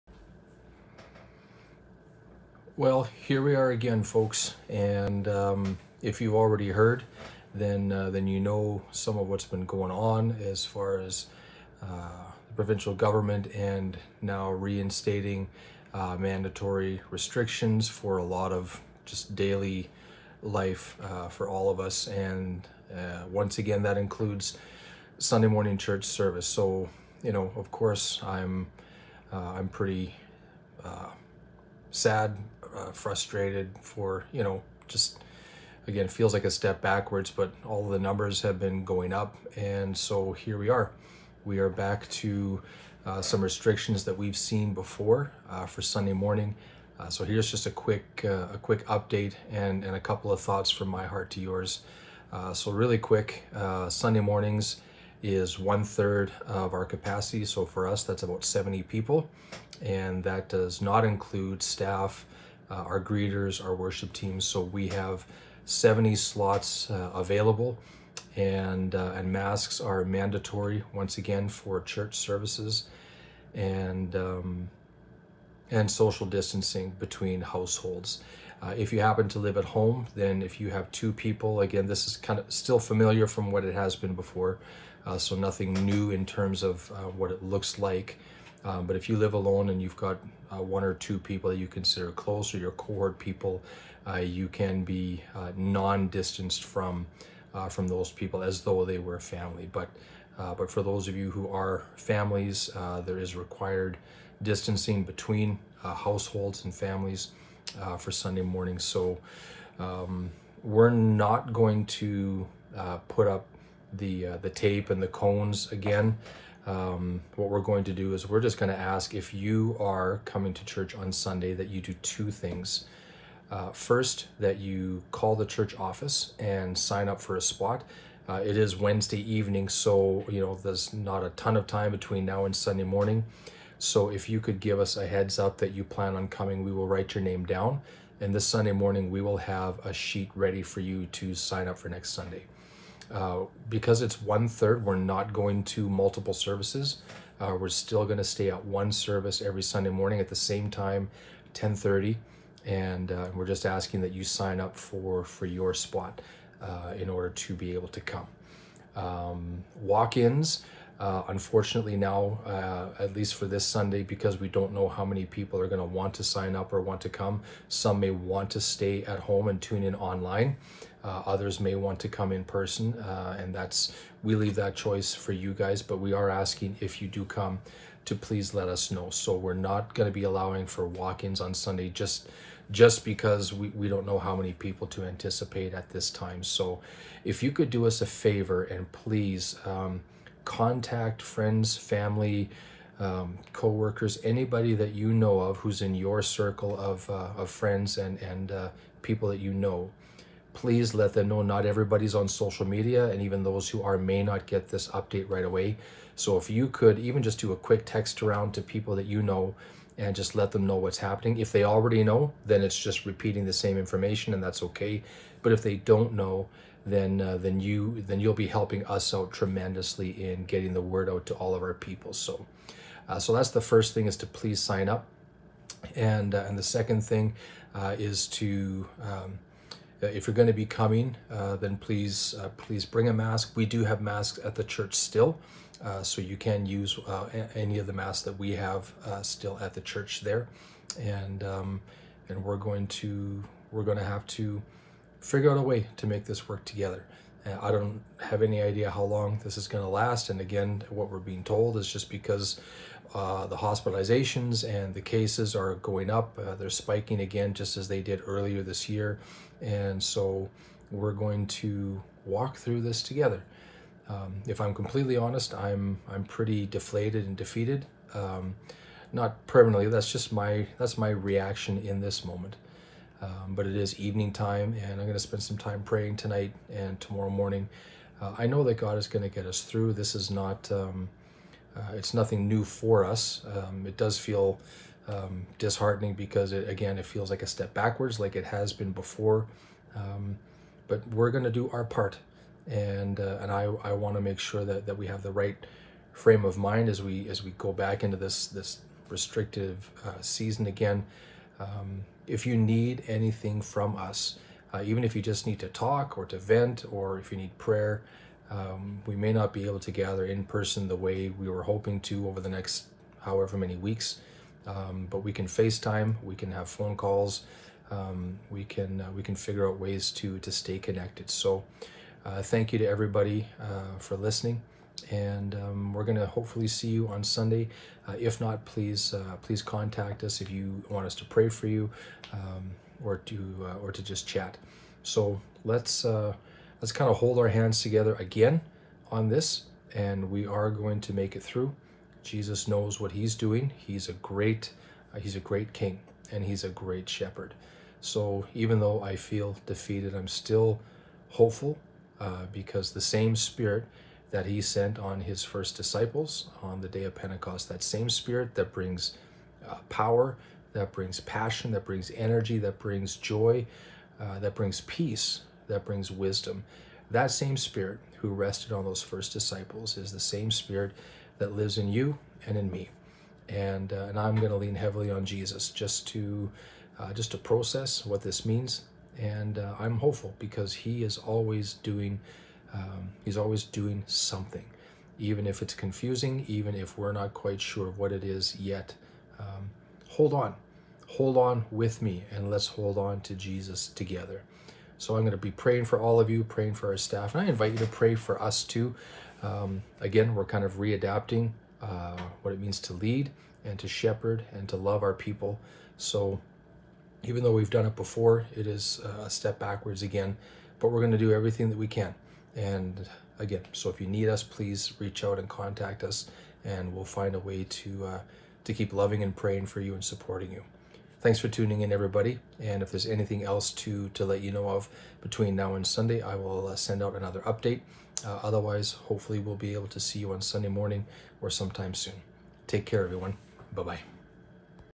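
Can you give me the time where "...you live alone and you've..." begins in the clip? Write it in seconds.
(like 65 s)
89 s.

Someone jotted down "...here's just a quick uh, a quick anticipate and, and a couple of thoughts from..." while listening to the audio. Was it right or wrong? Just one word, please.
wrong.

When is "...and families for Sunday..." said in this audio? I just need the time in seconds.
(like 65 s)
106 s.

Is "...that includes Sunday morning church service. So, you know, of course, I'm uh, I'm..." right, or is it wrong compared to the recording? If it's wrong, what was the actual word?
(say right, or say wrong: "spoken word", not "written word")
right.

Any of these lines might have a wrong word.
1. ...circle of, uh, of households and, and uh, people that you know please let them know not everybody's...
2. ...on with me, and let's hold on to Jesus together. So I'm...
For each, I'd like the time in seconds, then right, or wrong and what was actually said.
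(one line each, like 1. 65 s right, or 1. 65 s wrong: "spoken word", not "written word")
1. 196 s wrong: "friends", not "households"
2. 391 s right.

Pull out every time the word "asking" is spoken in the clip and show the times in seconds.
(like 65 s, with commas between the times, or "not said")
153 s, 176 s.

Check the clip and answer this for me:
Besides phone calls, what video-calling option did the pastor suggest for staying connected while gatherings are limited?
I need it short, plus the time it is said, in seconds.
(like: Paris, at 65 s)
FaceTime, at 315 s.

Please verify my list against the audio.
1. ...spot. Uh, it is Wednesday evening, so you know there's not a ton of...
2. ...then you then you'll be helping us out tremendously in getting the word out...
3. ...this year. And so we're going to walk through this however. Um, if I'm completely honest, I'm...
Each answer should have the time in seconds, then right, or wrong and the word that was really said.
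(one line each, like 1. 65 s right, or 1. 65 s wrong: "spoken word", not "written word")
1. 127 s right
2. 217 s right
3. 258 s wrong: "together", not "however".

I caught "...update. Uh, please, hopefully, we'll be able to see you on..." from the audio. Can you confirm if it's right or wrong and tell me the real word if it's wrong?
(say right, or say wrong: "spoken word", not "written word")
wrong: "otherwise", not "please".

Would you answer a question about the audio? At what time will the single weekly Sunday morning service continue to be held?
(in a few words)
10:30.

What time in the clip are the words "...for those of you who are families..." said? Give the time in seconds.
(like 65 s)
100 s.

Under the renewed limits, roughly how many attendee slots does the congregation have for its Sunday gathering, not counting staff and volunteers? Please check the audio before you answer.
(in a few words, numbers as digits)
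70.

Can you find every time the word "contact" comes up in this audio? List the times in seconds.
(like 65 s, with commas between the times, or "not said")
190 s, 329 s, 415 s.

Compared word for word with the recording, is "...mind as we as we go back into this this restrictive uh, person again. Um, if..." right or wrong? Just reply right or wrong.
wrong.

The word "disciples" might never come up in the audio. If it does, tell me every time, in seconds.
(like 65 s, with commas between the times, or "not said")
355 s, 369 s.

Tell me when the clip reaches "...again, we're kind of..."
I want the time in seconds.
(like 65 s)
399 s.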